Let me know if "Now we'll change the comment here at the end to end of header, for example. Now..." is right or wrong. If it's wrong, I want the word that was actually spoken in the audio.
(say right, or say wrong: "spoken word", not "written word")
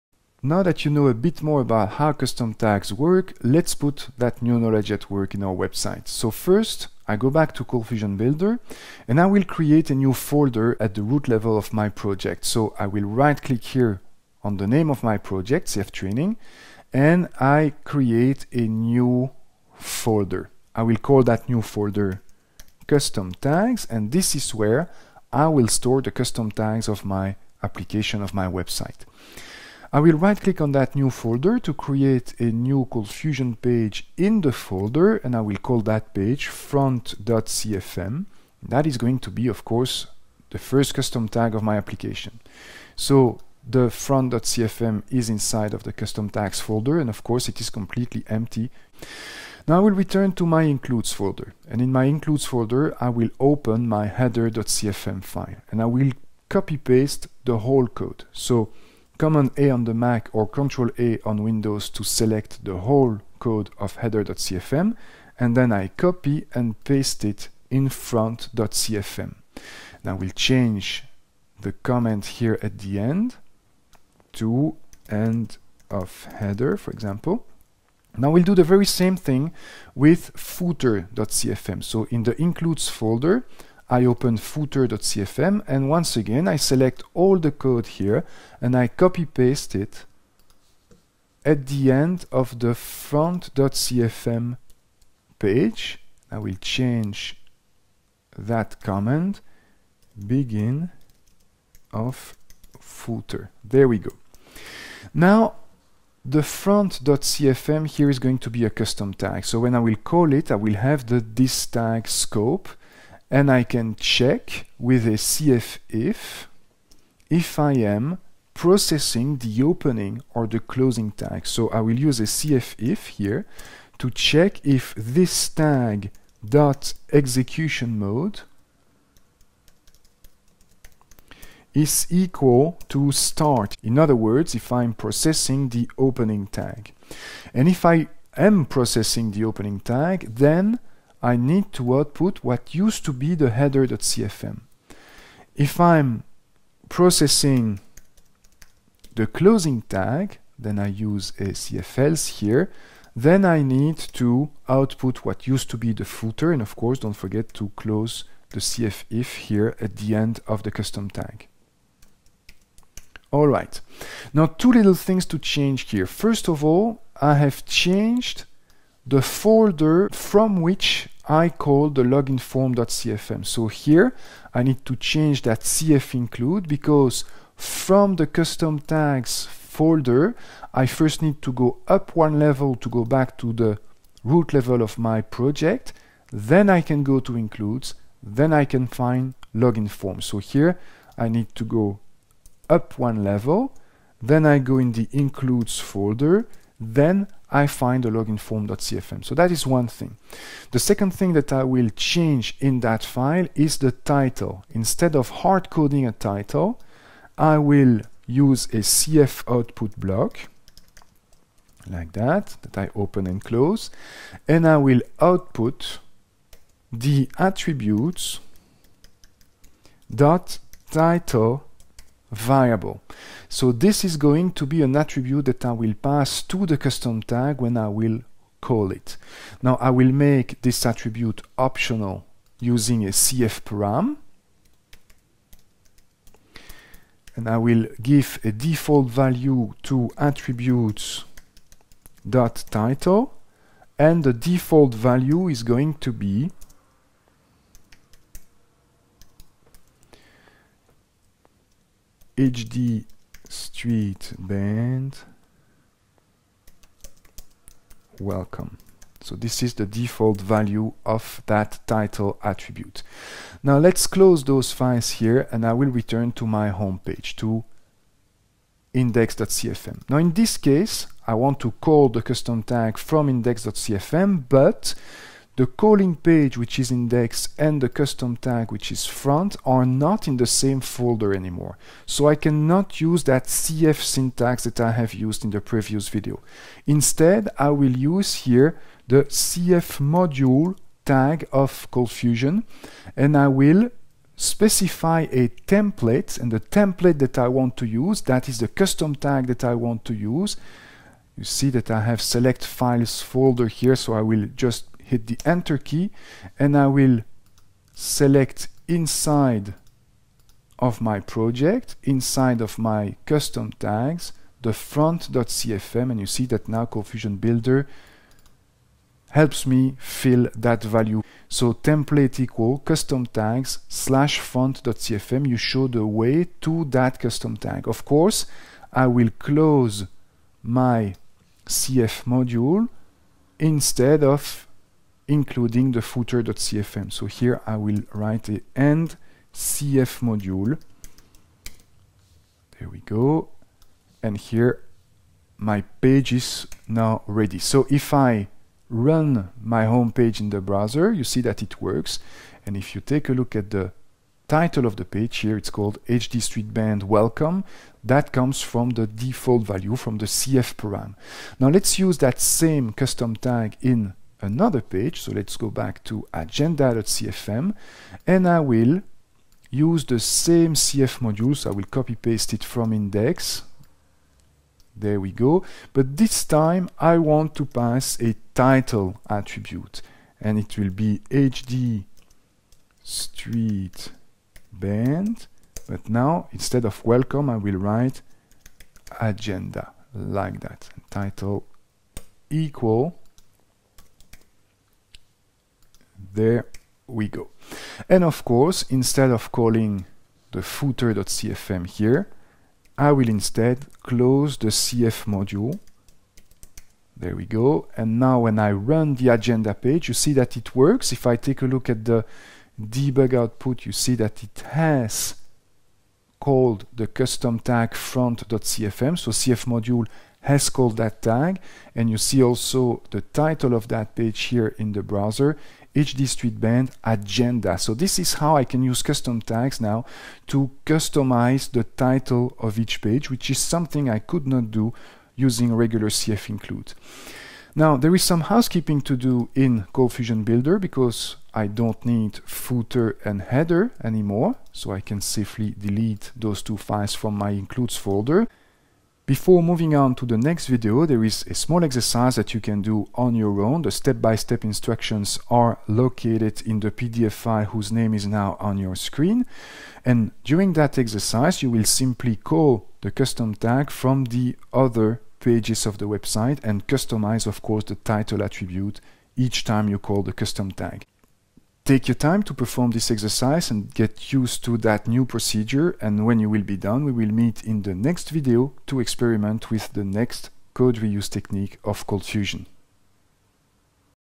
right.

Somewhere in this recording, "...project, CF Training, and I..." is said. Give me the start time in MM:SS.
00:15.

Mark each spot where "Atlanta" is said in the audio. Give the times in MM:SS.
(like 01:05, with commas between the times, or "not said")
not said.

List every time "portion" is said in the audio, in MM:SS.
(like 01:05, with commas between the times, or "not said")
not said.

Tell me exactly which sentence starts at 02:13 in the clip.
In other words, if I'm processing the opening tag.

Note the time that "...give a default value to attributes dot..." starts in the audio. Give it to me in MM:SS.
03:58.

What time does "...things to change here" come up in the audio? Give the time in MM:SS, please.
02:44.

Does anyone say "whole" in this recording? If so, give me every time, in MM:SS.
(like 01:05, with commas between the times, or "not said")
00:57, 01:02.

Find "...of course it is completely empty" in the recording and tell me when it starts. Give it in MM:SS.
00:47.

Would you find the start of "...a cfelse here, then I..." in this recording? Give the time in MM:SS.
02:31.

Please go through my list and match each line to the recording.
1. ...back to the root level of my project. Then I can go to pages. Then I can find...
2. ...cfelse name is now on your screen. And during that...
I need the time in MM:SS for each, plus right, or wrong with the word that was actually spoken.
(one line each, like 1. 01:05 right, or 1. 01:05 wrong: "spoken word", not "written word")
1. 03:03 wrong: "includes", not "pages"
2. 07:37 wrong: "whose", not "cfelse".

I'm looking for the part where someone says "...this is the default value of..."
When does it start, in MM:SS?
04:19.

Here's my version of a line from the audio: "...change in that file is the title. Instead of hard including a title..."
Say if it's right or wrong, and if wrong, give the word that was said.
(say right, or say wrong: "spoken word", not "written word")
wrong: "coding", not "including".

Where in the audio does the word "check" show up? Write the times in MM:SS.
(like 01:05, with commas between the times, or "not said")
01:53, 02:04.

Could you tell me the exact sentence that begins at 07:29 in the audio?
Before moving on to the next video, there is a small exercise that you can do on your own.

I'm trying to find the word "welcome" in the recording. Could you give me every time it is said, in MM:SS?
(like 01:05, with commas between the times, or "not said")
04:18, 05:57, 06:27.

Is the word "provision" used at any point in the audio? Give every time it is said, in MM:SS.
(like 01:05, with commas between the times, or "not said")
not said.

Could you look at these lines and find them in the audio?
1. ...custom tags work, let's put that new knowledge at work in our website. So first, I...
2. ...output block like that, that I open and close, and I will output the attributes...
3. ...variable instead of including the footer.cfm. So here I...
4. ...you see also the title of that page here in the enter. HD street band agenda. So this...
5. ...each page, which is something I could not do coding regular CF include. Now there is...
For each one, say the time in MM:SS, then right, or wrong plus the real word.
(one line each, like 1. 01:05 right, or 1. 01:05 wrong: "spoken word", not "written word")
1. 00:02 right
2. 03:29 right
3. 05:32 wrong: "module", not "variable"
4. 07:02 wrong: "browser", not "enter"
5. 07:12 wrong: "using", not "coding".